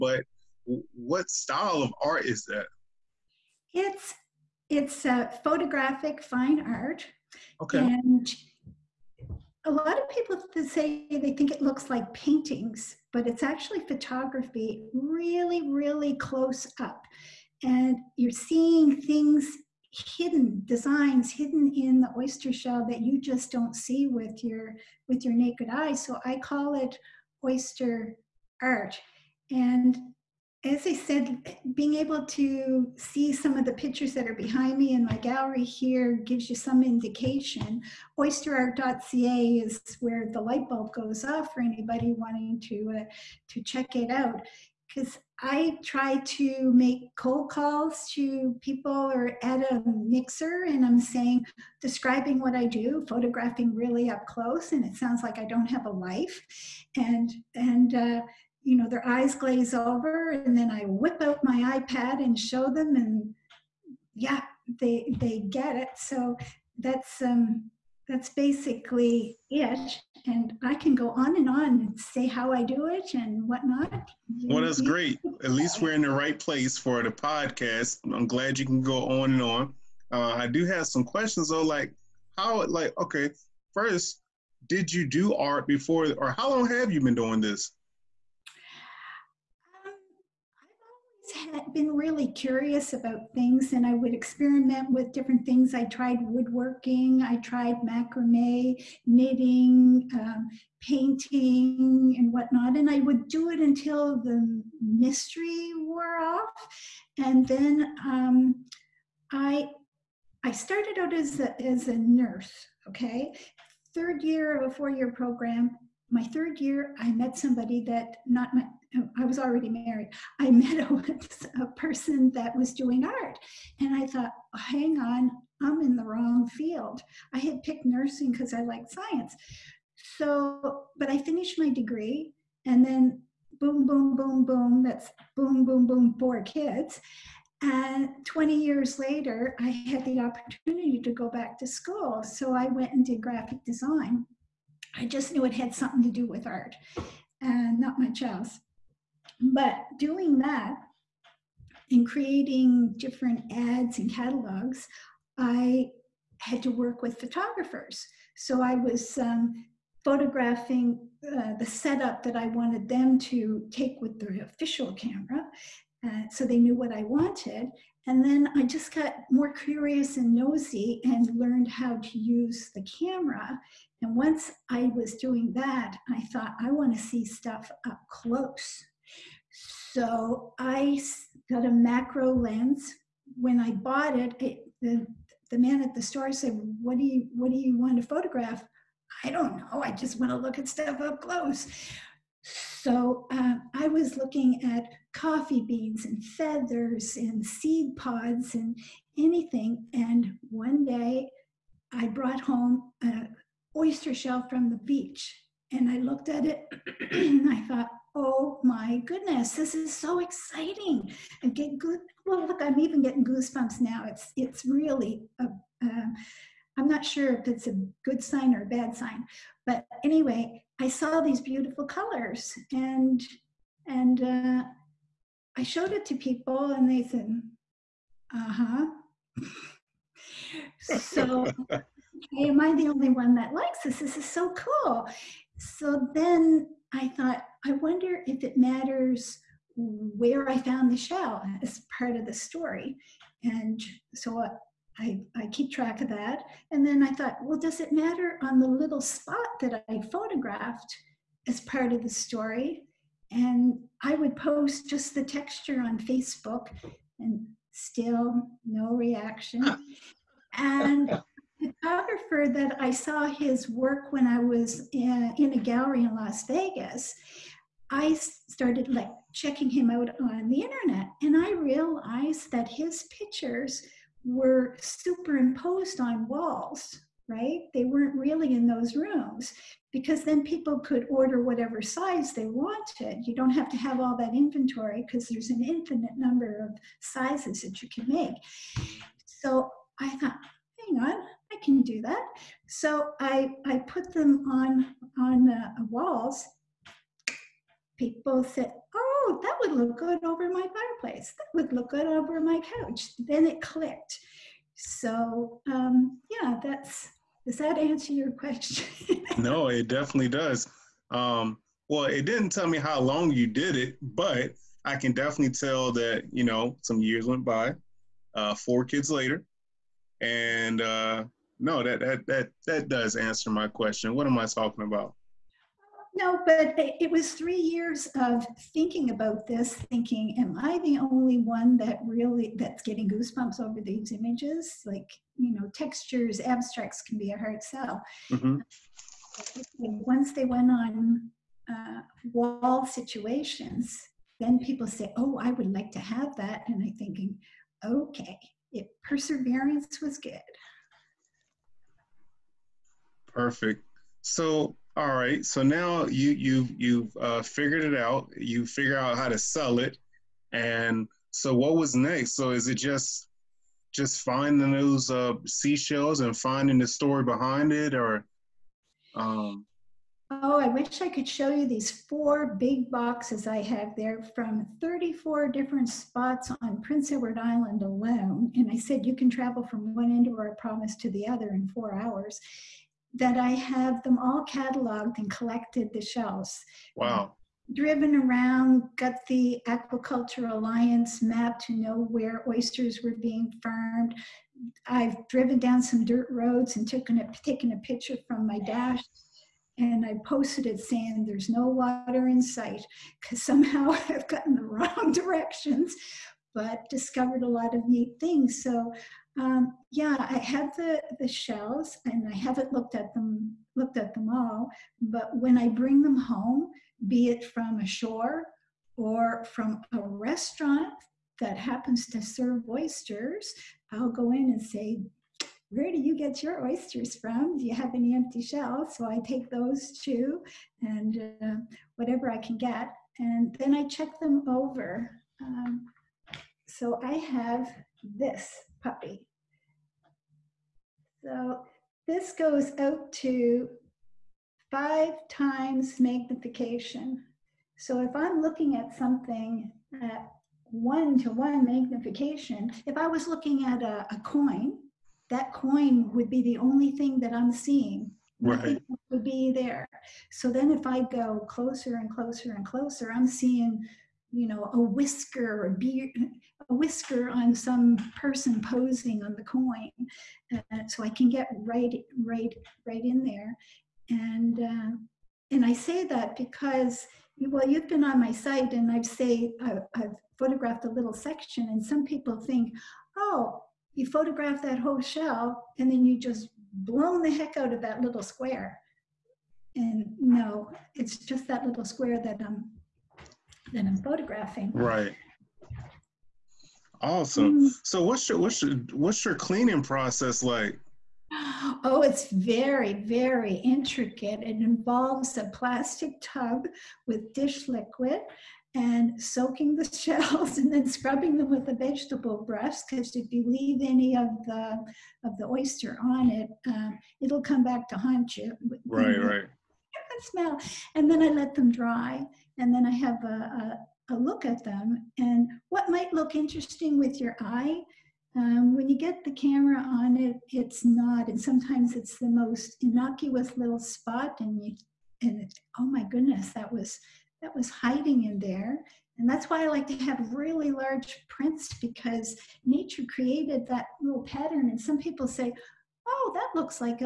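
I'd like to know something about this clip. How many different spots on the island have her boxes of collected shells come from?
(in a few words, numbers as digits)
34.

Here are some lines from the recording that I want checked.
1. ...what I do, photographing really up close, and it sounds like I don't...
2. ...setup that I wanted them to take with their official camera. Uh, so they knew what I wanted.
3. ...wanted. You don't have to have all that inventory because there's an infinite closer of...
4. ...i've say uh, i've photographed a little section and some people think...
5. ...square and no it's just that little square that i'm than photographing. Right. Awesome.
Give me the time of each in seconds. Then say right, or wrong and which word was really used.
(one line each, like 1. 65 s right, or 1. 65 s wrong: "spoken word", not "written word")
1. 52 s right
2. 161 s right
3. 282 s wrong: "number", not "closer"
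4. 478 s right
5. 488 s right.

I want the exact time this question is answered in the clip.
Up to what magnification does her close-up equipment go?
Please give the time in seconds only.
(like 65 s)
444 s.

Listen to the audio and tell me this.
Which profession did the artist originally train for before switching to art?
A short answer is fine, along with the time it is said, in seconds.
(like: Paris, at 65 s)
nurse, at 111 s.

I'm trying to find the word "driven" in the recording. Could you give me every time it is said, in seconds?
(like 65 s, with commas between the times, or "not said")
387 s, 395 s.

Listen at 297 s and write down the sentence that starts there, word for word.
People said, oh, that would look good over my fireplace.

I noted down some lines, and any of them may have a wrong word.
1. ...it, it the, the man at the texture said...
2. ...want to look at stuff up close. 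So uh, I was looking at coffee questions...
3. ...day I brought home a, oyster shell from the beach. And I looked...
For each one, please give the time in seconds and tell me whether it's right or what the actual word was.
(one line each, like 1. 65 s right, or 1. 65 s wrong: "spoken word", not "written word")
1. 184 s wrong: "store", not "texture"
2. 190 s wrong: "beans", not "questions"
3. 200 s right.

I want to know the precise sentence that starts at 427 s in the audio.
Do you have any empty shells?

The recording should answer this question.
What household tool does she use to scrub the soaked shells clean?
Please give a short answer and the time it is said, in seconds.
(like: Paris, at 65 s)
vegetable brush, at 511 s.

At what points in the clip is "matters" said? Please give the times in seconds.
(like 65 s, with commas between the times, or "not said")
238 s, 247 s.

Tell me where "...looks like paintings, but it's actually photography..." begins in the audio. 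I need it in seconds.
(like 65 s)
11 s.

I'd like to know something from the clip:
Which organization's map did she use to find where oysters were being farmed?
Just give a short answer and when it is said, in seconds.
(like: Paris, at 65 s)
Aquaculture Alliance, at 389 s.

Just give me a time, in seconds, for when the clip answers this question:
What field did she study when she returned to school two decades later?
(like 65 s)
143 s.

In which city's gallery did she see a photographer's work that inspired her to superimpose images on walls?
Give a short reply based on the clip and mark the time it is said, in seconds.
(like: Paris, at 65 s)
Las Vegas, at 266 s.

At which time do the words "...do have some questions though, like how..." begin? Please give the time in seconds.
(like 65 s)
80 s.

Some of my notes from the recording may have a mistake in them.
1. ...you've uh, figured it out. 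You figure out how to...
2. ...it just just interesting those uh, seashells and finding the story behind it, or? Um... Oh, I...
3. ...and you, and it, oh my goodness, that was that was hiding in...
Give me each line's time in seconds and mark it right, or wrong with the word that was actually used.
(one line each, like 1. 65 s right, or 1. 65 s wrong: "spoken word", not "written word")
1. 356 s right
2. 362 s wrong: "finding", not "interesting"
3. 534 s right.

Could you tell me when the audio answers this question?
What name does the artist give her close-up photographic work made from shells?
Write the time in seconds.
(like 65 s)
27 s.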